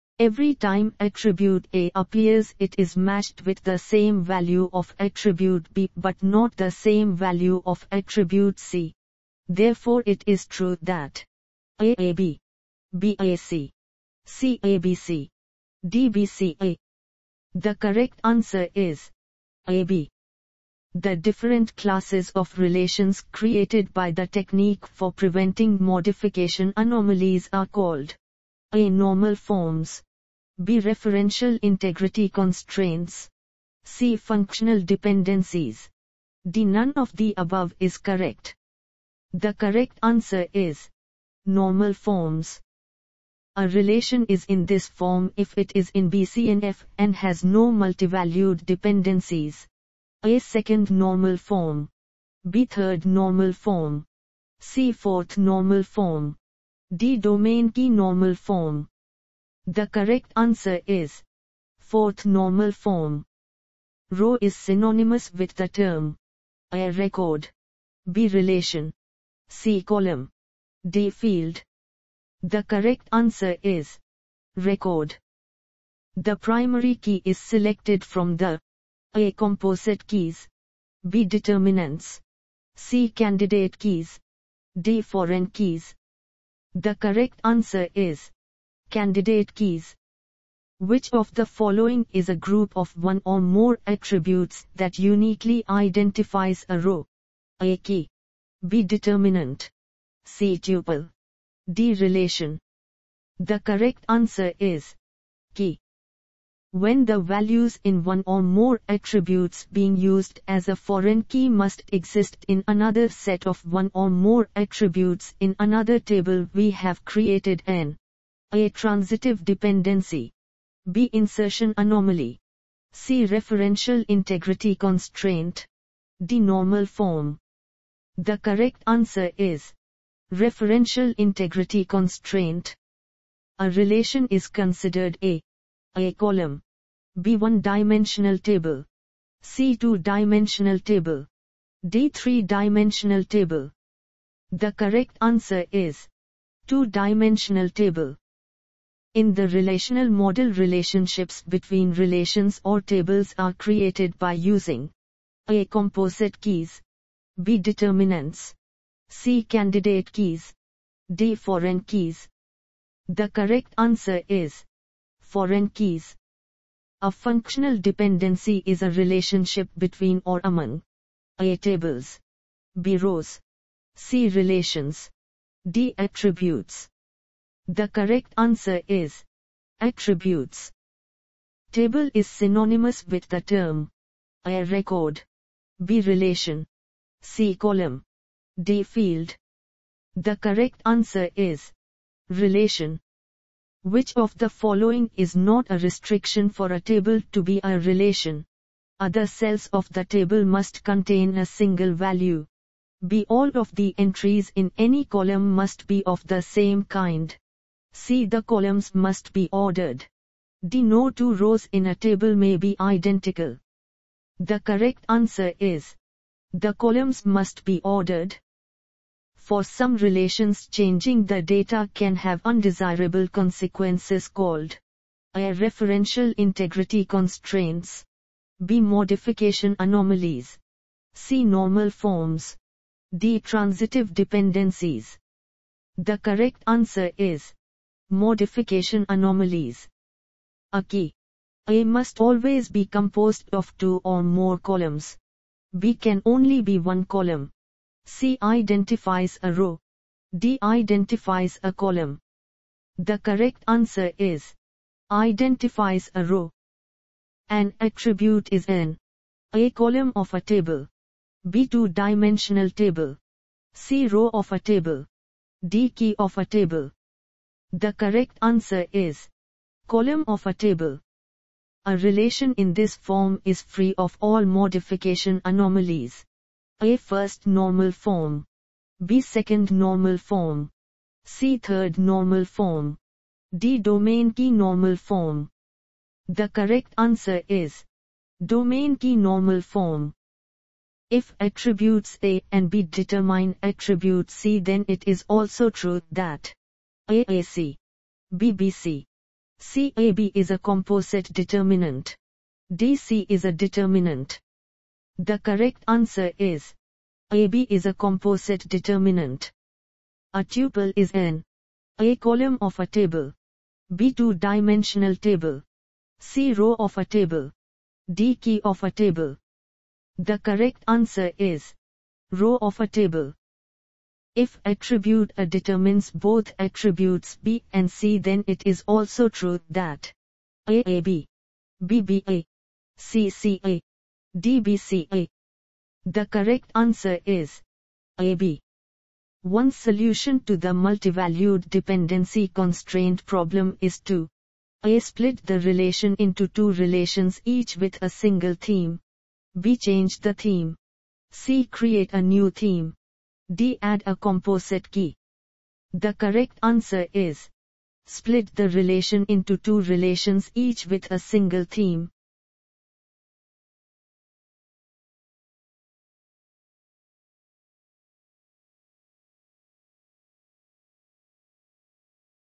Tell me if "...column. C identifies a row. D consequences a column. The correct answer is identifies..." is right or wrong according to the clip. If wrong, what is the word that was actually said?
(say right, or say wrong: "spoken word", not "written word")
wrong: "identifies", not "consequences".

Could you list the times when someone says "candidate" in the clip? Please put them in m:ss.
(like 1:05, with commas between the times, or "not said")
1:23, 1:28, 2:39.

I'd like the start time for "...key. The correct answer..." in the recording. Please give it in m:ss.
5:54.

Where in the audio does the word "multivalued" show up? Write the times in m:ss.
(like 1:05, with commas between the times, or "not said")
0:47, 5:40.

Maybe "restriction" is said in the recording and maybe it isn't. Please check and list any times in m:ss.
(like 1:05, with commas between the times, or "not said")
3:15.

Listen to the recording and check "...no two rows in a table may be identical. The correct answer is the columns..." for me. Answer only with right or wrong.
right.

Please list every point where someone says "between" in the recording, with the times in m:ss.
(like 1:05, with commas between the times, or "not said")
2:31, 2:49.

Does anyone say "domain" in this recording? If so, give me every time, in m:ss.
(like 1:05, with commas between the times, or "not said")
0:57, 4:43, 4:48.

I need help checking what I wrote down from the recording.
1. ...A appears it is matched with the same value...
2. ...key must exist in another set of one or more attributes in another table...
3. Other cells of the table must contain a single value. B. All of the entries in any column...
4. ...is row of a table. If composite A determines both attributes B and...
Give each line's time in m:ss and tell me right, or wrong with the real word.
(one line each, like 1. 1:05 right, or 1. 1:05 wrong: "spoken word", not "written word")
1. 0:01 right
2. 1:51 right
3. 3:18 right
4. 5:21 wrong: "attribute", not "composite".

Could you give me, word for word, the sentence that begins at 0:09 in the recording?
Therefore it is true that AAB, BAC, CABC, DBCA.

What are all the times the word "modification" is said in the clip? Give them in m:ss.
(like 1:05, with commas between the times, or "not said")
0:25, 3:48, 3:58, 4:34.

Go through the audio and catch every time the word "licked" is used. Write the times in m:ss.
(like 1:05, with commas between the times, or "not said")
not said.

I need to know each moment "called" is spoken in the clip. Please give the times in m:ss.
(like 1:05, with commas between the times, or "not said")
0:27, 3:44.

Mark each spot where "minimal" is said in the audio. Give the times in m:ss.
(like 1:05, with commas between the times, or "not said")
not said.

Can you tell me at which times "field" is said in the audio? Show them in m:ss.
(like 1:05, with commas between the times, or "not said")
1:11, 3:08.